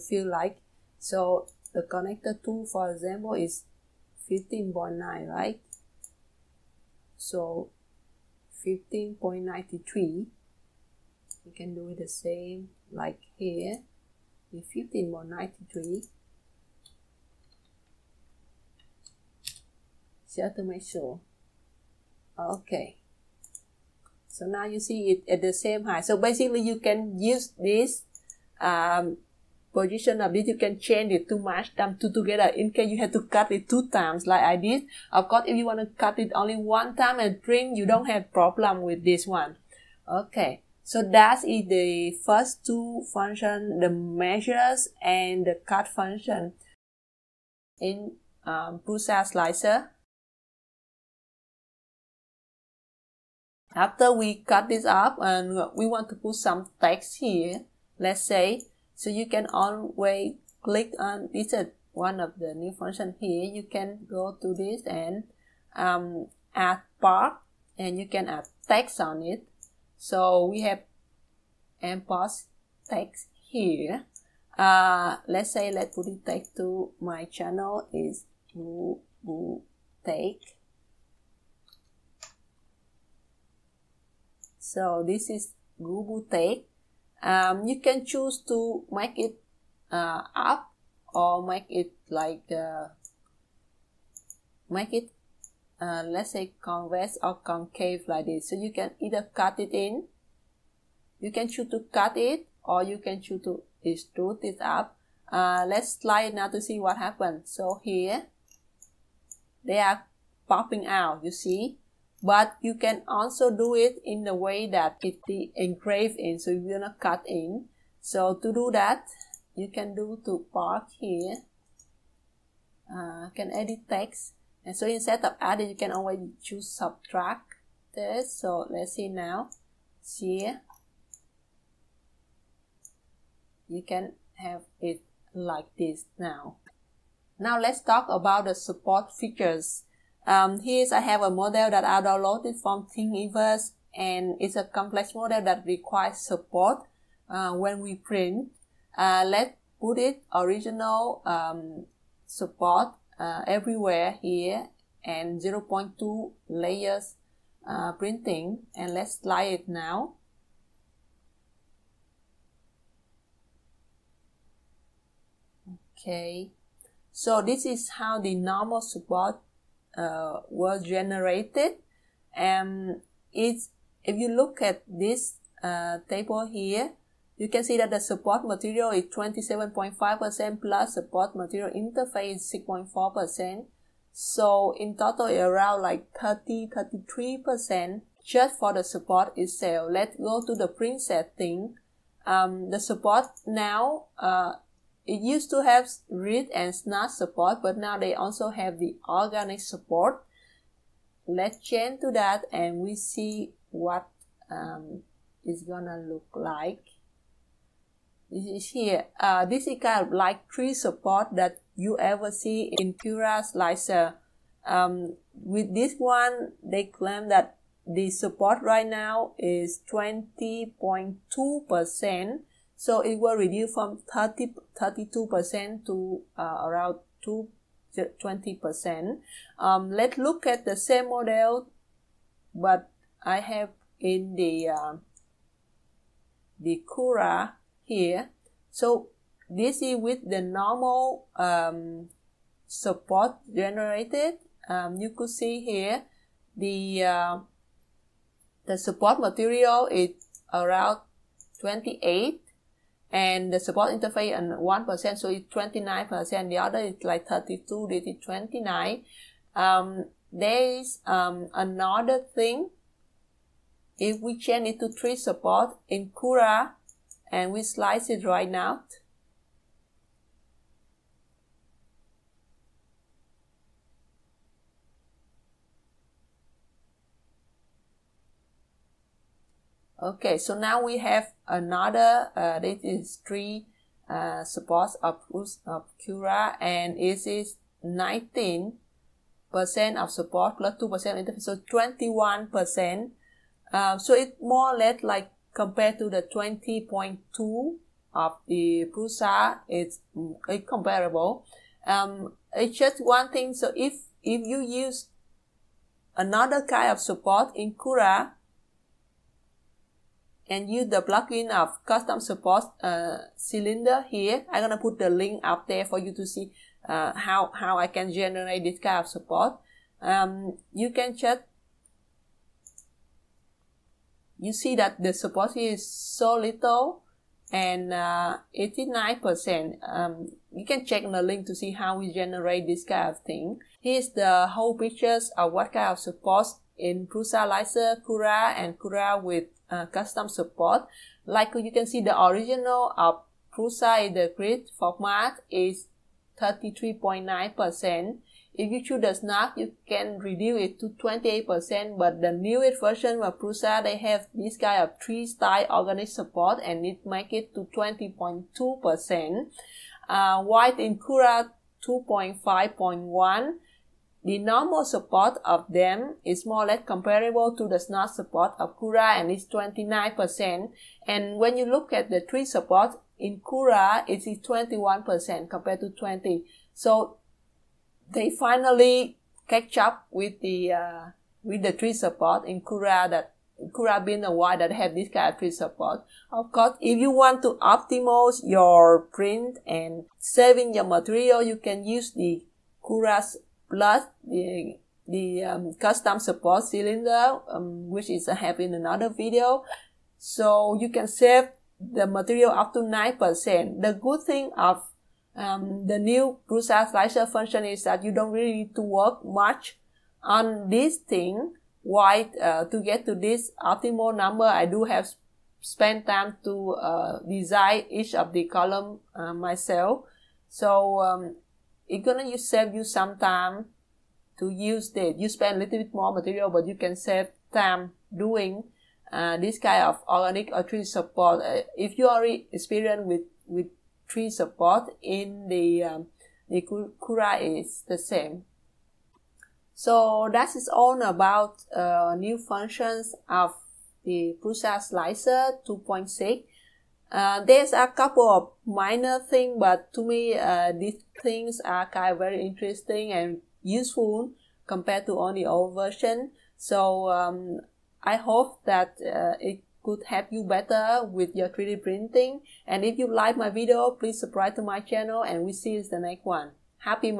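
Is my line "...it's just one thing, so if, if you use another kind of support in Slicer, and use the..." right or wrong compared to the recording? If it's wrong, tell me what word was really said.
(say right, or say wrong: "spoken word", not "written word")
wrong: "Cura", not "Slicer".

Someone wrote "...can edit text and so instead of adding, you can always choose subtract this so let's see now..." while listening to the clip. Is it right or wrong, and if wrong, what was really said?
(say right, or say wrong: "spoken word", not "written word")
right.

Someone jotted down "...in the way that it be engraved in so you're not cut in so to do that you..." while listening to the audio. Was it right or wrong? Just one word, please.
right.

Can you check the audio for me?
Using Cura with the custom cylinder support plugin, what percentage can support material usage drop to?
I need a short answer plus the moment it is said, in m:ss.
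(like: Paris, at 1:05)
9%, at 6:42.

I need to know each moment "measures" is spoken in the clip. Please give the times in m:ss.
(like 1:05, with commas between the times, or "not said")
0:43.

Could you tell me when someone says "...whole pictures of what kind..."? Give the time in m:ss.
5:34.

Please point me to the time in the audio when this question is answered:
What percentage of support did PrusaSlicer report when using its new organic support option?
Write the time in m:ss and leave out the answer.
3:39.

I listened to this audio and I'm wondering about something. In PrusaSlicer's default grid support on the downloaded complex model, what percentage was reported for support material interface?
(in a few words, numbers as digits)
6.4%.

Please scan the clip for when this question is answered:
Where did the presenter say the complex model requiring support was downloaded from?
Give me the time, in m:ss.
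2:22.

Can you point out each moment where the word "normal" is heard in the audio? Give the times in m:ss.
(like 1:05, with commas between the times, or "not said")
2:48, 4:00, 6:04.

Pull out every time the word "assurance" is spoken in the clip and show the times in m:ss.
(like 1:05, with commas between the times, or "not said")
not said.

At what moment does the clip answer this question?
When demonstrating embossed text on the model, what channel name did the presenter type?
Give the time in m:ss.
1:25.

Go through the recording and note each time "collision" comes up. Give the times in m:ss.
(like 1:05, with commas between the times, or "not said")
not said.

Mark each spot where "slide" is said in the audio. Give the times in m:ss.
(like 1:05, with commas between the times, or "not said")
1:45, 2:39.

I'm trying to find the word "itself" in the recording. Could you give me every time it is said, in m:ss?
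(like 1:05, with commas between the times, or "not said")
3:09.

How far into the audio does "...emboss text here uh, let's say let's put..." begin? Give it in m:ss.
1:11.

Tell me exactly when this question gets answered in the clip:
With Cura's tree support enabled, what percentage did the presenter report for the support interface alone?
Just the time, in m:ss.
4:50.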